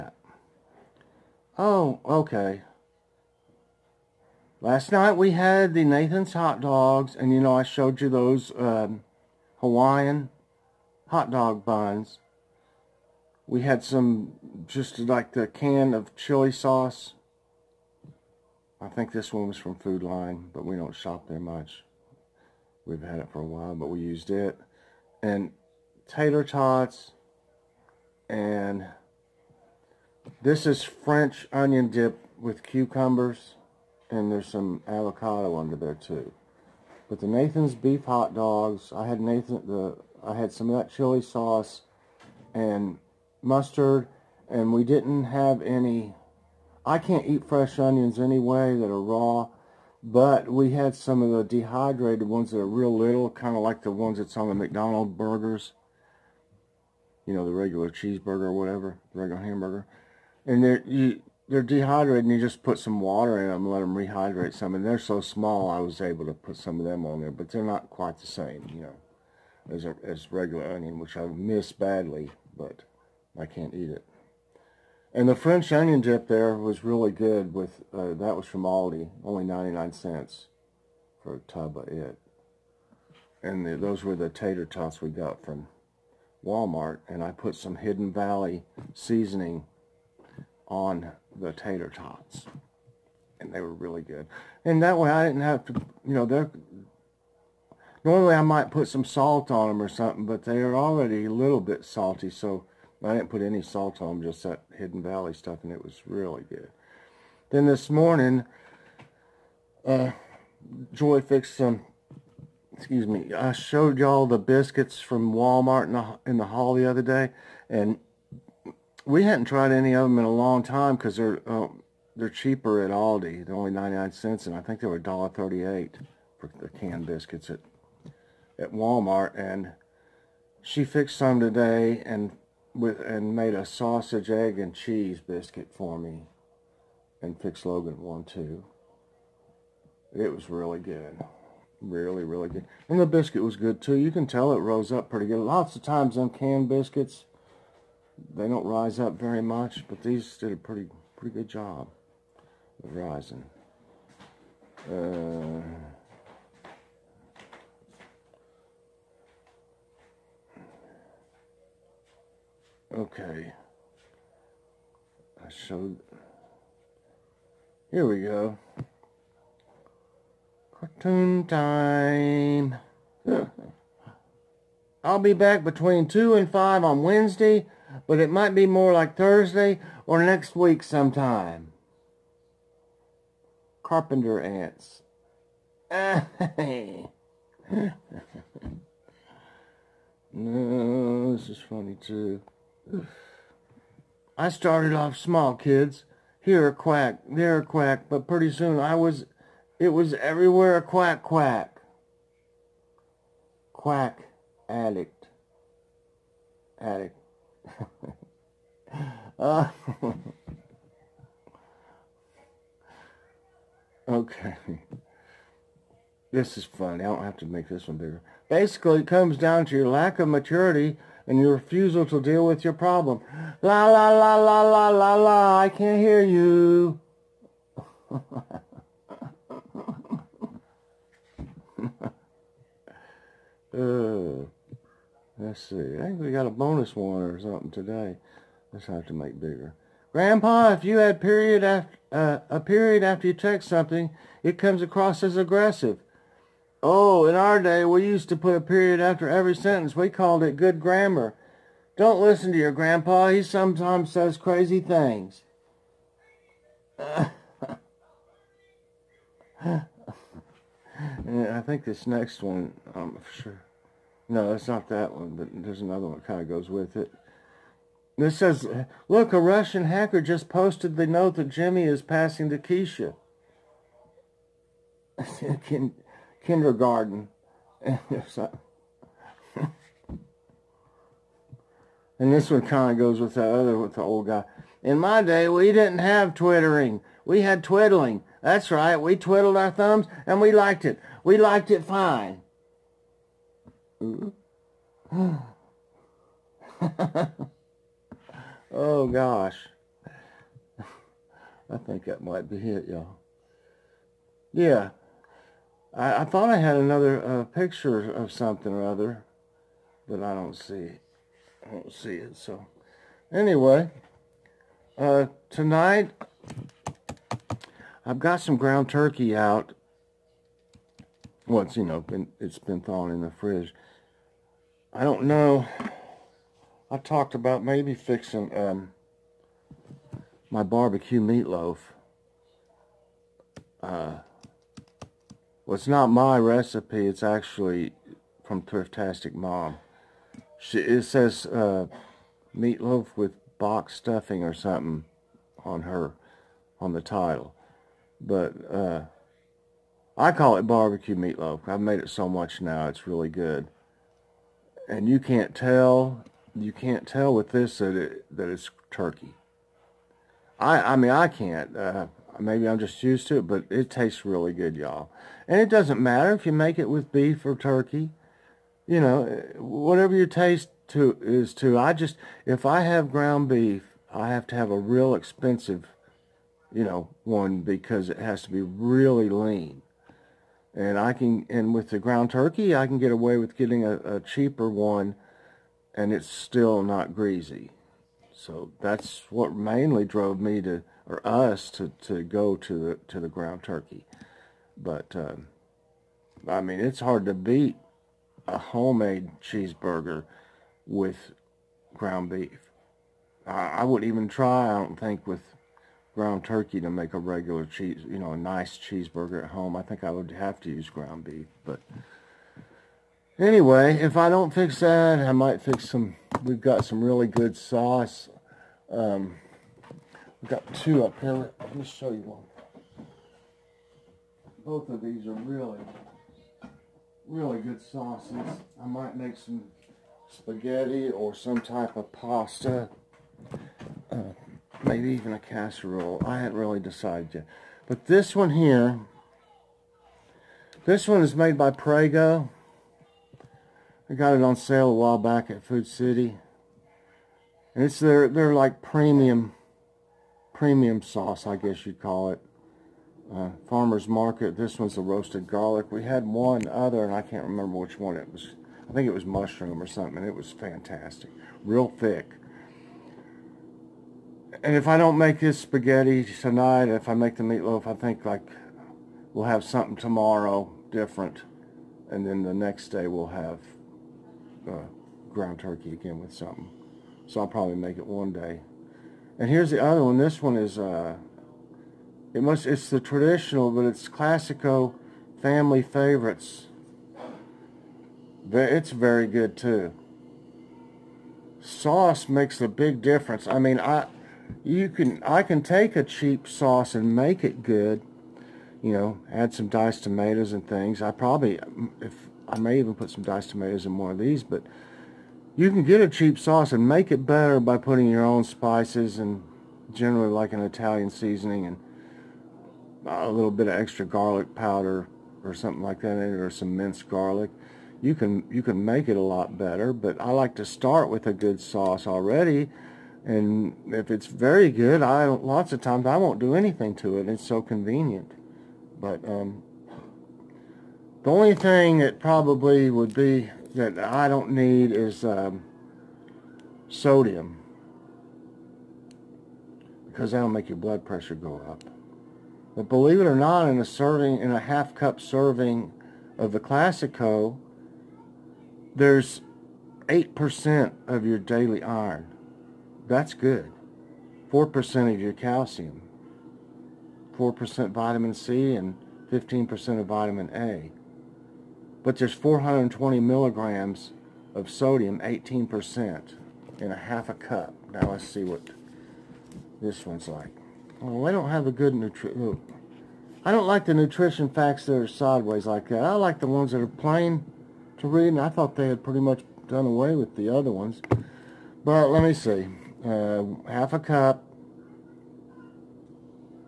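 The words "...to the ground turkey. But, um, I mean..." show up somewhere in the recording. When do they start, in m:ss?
6:33.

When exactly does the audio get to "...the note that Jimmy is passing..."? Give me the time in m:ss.
4:30.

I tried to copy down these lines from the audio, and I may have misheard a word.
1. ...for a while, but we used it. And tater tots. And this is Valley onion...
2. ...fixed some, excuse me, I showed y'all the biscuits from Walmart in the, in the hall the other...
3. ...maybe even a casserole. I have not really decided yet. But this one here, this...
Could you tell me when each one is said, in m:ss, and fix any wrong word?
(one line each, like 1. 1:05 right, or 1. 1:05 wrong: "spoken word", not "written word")
1. 0:23 wrong: "French", not "Valley"
2. 1:51 right
3. 7:14 right.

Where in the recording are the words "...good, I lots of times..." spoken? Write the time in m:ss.
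8:44.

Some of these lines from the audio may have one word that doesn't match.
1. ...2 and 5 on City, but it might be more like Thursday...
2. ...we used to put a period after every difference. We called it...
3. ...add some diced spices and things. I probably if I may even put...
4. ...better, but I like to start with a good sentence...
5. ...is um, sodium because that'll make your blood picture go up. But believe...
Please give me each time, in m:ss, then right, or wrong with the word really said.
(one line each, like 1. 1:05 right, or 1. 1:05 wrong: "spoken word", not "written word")
1. 2:56 wrong: "Wednesday", not "City"
2. 4:07 wrong: "sentence", not "difference"
3. 8:19 wrong: "tomatoes", not "spices"
4. 8:39 wrong: "sauce", not "sentence"
5. 8:54 wrong: "pressure", not "picture".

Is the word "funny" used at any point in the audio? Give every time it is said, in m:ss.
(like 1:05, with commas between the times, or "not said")
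3:11, 3:36.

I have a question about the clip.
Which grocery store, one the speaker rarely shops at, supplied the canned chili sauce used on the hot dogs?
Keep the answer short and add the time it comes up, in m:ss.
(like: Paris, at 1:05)
Food Lion, at 0:19.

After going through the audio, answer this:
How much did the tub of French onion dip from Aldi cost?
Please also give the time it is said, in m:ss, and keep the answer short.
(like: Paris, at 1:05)
99 cents, at 1:19.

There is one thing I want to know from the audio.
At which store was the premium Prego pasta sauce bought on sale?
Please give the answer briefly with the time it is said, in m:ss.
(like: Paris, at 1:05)
Food City, at 7:25.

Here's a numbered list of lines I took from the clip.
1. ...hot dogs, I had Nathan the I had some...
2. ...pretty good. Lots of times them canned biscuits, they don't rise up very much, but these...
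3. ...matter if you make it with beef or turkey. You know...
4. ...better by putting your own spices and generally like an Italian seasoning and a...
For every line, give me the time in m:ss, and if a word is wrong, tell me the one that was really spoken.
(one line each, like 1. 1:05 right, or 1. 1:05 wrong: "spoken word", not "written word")
1. 0:38 right
2. 2:25 right
3. 6:06 right
4. 8:27 right.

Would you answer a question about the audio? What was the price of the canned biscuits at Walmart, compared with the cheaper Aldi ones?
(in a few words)
$1.38.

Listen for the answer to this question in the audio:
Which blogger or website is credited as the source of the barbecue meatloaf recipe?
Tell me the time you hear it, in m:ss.
5:38.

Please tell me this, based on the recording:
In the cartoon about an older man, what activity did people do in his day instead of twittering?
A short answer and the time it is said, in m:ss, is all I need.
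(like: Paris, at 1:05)
Twiddling, at 4:47.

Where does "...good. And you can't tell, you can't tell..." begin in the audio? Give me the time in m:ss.
5:53.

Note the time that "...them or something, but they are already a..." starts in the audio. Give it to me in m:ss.
1:39.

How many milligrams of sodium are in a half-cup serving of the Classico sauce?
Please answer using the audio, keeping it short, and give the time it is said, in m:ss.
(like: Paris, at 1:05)
420 milligrams, at 9:22.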